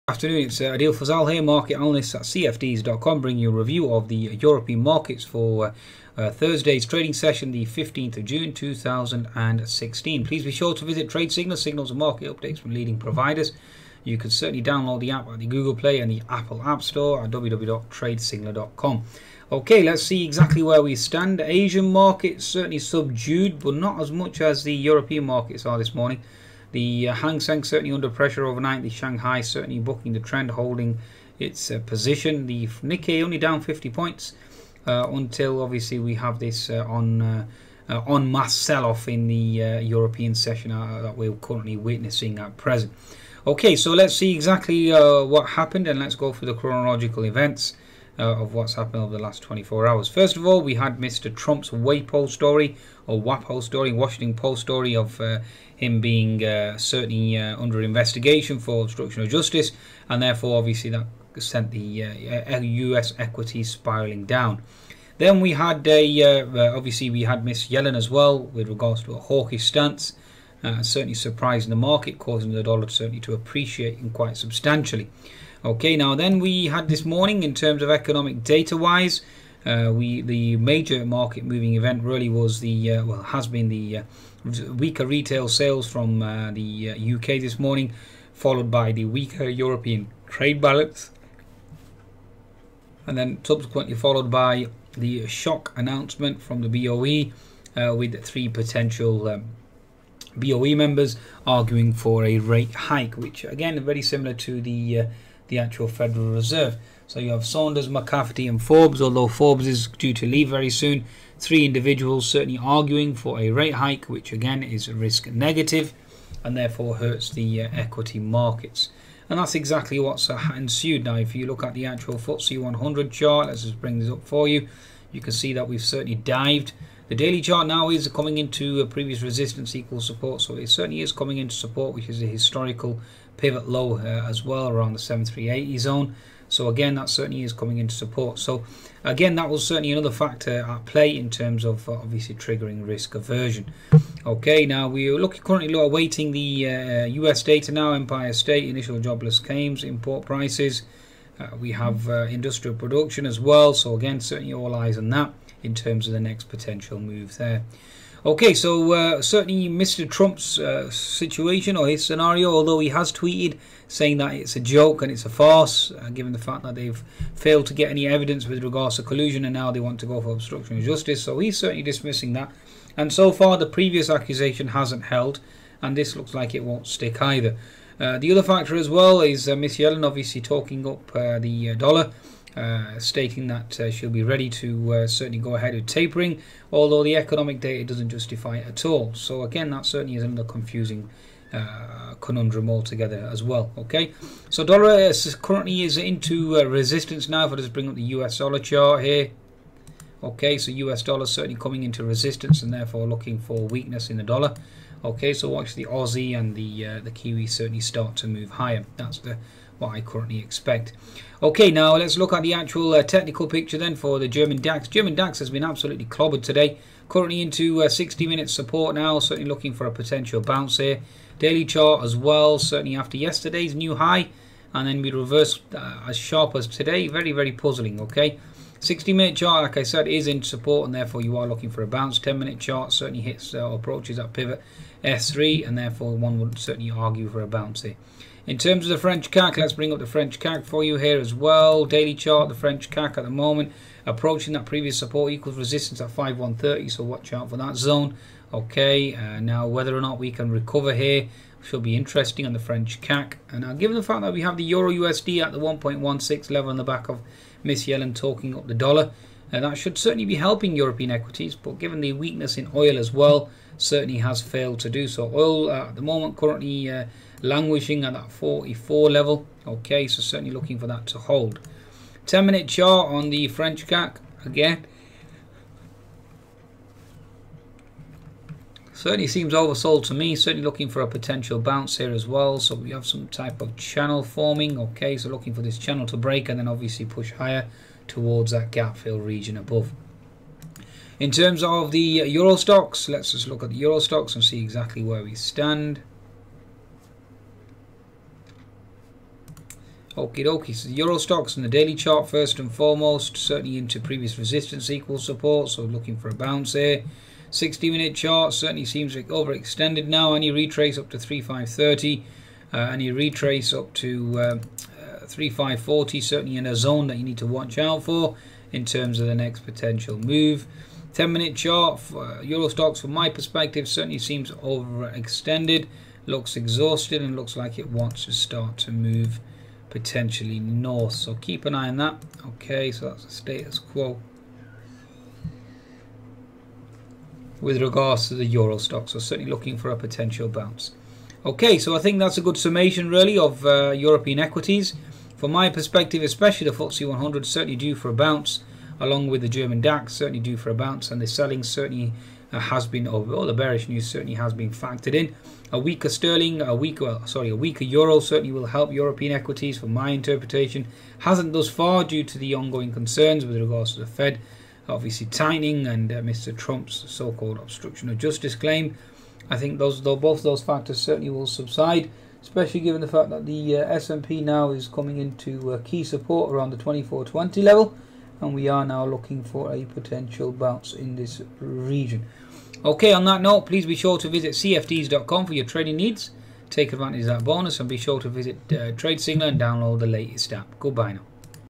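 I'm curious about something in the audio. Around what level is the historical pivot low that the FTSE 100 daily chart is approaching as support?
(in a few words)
7380.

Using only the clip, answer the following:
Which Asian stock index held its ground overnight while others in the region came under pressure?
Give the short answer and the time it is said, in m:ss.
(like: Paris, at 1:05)
Shanghai, at 0:28.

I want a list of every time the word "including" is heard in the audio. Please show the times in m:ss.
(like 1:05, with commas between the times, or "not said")
not said.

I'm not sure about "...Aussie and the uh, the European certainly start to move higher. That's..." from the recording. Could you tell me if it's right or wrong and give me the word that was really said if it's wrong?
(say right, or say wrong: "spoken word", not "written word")
wrong: "Kiwi", not "European".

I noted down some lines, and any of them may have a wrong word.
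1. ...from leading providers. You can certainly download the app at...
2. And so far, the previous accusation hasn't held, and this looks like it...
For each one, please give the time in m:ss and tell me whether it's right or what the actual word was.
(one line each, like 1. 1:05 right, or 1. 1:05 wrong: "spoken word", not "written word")
1. 0:12 right
2. 2:52 right.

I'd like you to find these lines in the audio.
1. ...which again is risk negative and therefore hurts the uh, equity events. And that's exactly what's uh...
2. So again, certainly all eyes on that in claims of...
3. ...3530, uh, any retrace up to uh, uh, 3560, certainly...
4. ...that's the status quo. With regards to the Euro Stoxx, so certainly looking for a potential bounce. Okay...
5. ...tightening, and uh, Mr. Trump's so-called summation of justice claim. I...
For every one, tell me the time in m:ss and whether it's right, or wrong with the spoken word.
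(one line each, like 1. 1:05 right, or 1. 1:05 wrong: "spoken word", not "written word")
1. 1:54 wrong: "markets", not "events"
2. 2:33 wrong: "terms", not "claims"
3. 5:11 wrong: "3540", not "3560"
4. 5:33 right
5. 6:05 wrong: "obstruction", not "summation".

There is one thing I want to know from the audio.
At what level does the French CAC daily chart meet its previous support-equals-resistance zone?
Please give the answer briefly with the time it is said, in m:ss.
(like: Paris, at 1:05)
5130, at 4:06.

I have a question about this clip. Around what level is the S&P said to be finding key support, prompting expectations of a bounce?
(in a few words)
2420.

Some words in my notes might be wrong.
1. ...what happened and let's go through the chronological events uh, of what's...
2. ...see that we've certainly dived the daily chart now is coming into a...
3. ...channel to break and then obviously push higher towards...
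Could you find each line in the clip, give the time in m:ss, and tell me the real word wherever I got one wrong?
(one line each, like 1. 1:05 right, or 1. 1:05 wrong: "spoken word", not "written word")
1. 0:44 right
2. 2:05 right
3. 4:45 right.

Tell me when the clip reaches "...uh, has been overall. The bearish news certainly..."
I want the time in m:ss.
5:52.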